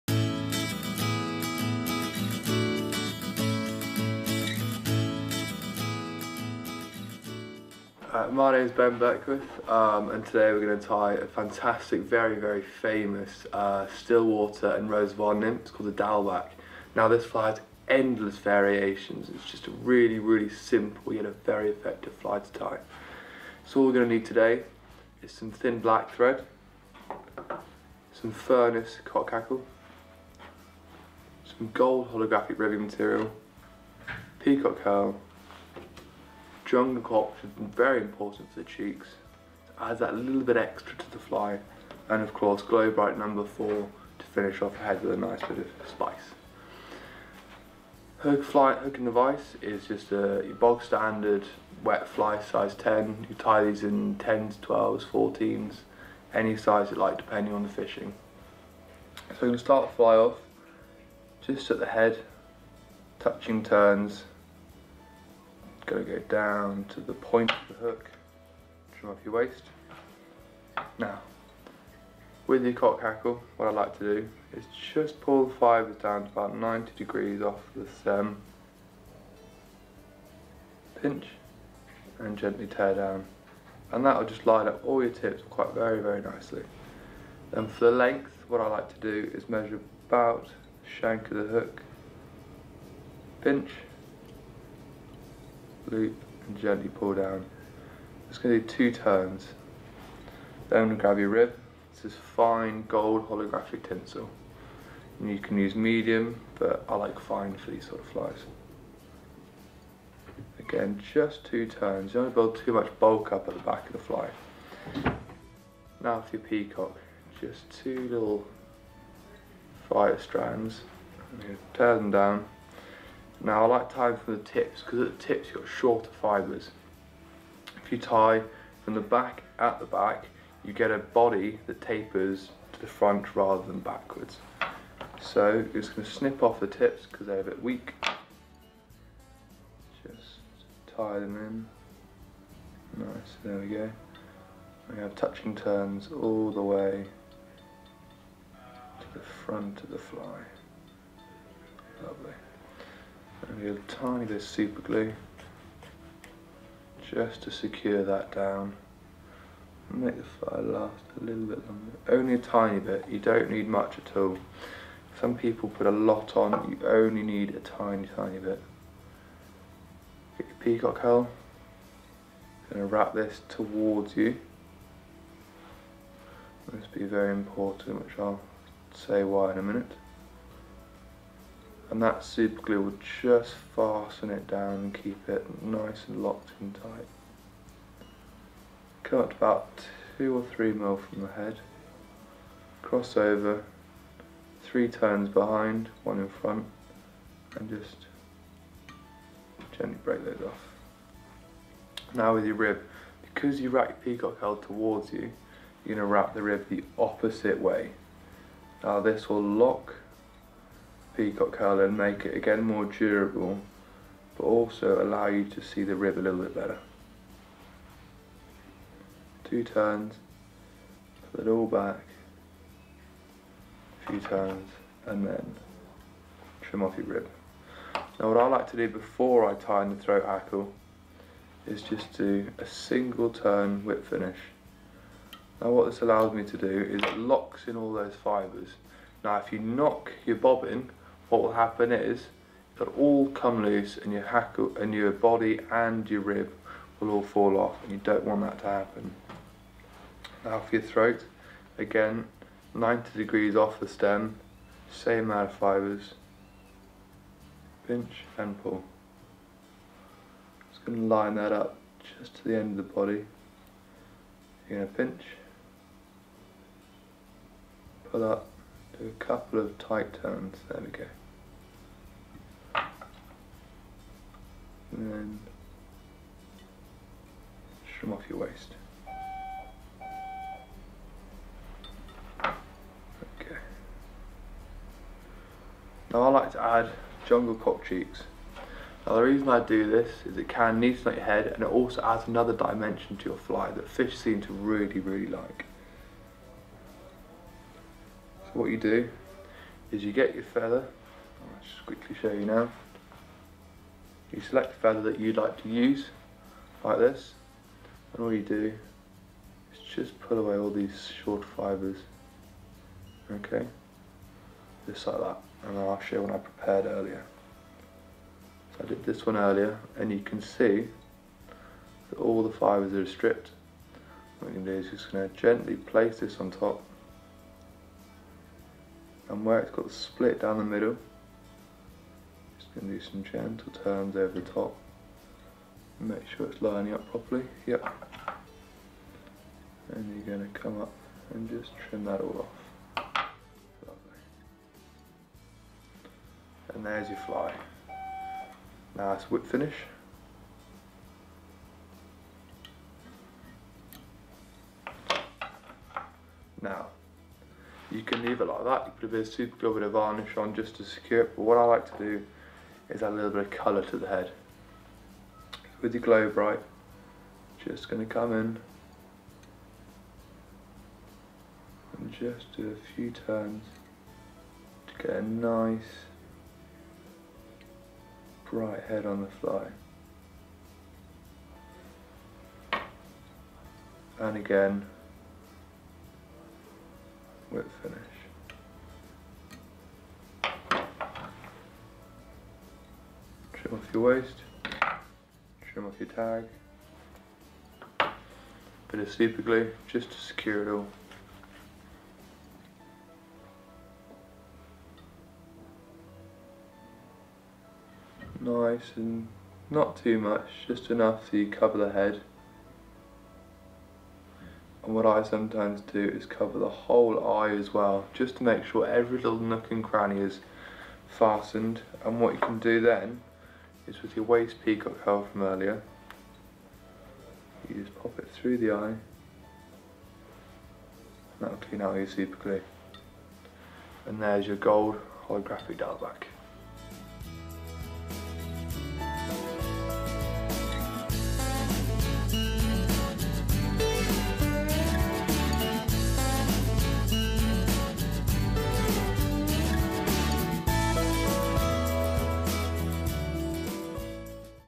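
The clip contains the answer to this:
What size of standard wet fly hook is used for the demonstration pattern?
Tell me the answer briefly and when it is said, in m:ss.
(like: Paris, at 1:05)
10, at 0:52.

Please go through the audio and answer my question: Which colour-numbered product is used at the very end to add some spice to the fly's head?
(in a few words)
Glo Brite number 4.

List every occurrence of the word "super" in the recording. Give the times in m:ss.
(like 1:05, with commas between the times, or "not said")
2:34, 3:02, 5:59, 6:39, 7:12.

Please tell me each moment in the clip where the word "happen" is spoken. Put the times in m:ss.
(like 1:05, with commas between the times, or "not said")
4:01, 4:08.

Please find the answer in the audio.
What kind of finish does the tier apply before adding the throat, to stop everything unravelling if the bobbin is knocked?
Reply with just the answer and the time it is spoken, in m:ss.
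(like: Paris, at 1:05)
Single turn whip finish, at 3:52.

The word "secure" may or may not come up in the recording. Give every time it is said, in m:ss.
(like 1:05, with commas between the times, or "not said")
2:37, 6:00, 6:40.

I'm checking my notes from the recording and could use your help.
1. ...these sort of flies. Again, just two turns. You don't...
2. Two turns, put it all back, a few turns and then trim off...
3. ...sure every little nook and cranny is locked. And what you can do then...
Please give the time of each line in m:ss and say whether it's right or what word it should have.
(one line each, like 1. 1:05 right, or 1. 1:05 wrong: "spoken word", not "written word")
1. 1:47 right
2. 3:39 right
3. 6:58 wrong: "fastened", not "locked".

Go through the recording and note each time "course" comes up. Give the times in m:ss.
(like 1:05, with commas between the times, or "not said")
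0:42.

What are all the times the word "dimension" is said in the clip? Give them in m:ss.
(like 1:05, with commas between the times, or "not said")
4:52.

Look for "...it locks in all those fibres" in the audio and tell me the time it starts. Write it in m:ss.
3:57.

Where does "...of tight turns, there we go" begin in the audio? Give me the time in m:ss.
4:29.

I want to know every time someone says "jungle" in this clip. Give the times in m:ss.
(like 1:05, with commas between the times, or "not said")
0:36, 4:47.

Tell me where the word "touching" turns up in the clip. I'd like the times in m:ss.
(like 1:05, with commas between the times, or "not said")
1:03, 2:25.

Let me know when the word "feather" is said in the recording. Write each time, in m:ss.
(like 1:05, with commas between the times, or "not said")
5:00, 5:04.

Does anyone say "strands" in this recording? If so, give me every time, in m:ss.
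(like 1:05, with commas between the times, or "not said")
2:00.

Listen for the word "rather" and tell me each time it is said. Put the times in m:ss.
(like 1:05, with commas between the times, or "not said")
2:13.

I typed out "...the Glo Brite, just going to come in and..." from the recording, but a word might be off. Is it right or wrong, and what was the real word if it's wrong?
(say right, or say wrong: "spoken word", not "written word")
right.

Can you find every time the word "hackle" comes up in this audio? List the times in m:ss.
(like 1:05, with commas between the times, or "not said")
0:29, 1:13, 3:50, 4:04.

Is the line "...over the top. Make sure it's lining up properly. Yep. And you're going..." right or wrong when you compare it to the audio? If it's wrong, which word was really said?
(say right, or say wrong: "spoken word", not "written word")
right.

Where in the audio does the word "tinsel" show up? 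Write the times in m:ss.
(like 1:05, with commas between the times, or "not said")
1:43.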